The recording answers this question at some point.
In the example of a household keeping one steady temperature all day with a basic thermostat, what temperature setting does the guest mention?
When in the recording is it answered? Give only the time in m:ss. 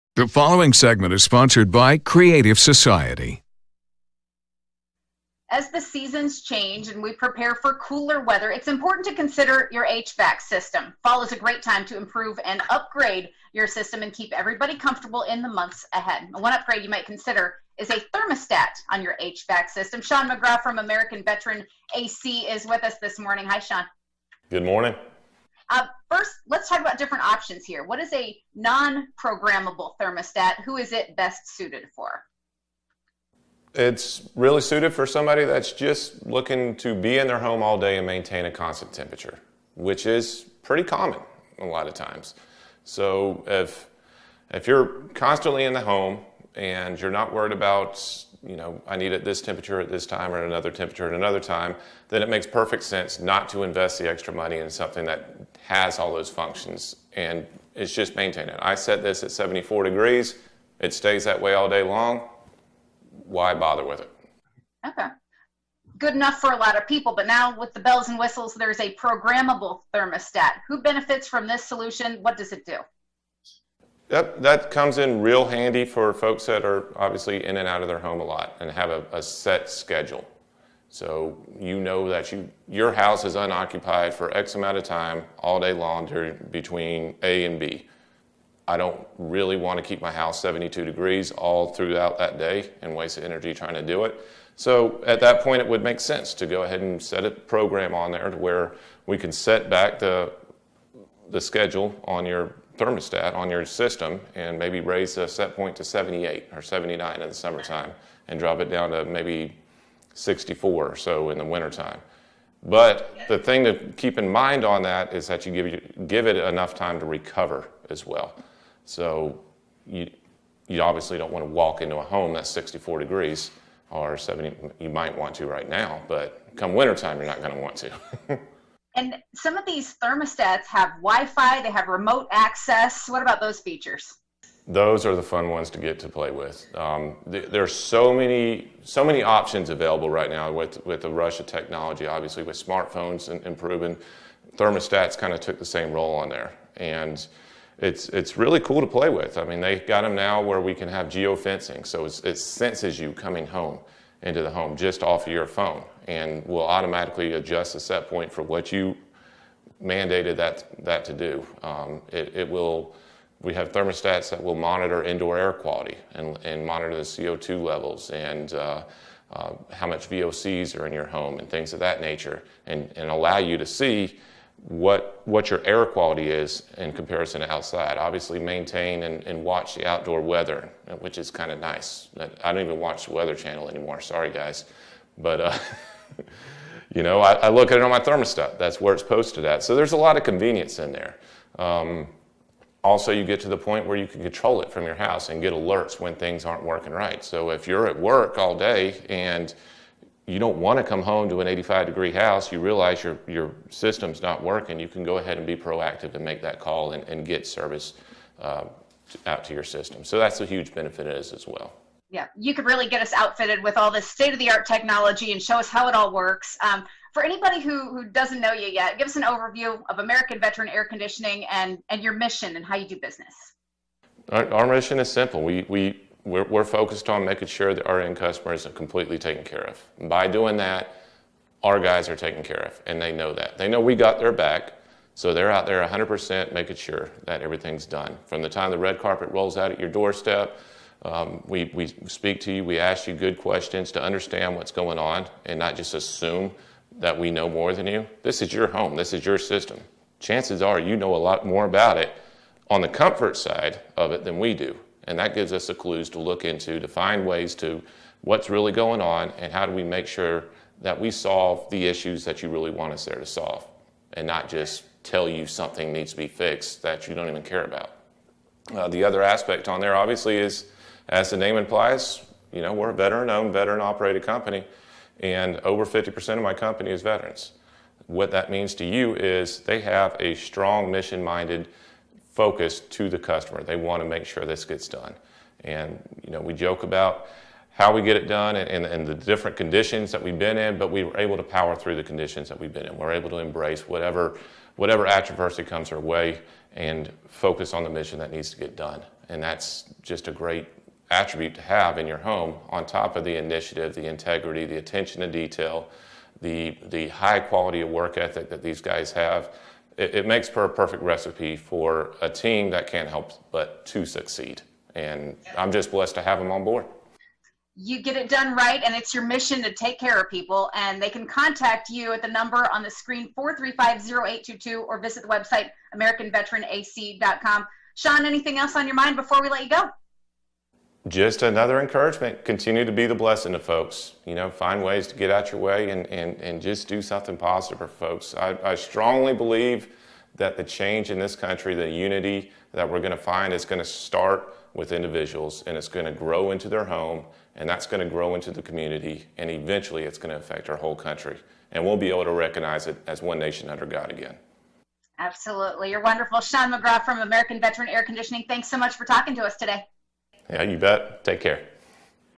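0:59.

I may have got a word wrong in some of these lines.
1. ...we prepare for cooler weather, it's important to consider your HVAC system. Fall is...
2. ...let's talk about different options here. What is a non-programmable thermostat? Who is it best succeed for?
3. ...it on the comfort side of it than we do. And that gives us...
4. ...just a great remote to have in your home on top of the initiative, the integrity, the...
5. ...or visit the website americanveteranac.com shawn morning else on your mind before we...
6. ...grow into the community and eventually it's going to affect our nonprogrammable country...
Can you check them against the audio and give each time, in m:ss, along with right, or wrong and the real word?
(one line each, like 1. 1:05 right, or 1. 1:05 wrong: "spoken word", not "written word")
1. 0:07 right
2. 0:26 wrong: "suited", not "succeed"
3. 4:11 right
4. 5:00 wrong: "attribute", not "remote"
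5. 5:24 wrong: "anything", not "morning"
6. 5:48 wrong: "whole", not "nonprogrammable".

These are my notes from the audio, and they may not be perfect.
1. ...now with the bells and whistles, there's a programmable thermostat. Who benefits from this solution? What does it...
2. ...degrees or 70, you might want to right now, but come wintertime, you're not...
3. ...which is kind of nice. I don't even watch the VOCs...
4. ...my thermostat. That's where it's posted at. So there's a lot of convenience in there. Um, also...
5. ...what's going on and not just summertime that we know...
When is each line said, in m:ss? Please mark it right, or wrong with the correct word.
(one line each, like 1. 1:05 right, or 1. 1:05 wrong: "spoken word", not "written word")
1. 1:07 right
2. 2:02 right
3. 3:00 wrong: "Weather", not "VOCs"
4. 3:07 right
5. 4:04 wrong: "assume", not "summertime".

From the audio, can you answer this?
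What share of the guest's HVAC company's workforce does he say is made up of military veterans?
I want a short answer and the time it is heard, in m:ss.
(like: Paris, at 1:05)
over 50%, at 4:35.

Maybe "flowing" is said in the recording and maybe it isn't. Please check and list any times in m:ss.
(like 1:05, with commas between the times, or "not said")
not said.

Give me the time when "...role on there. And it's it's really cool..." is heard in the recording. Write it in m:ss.
2:25.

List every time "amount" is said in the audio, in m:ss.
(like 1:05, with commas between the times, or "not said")
1:24.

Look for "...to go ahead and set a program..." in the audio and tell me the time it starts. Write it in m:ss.
1:36.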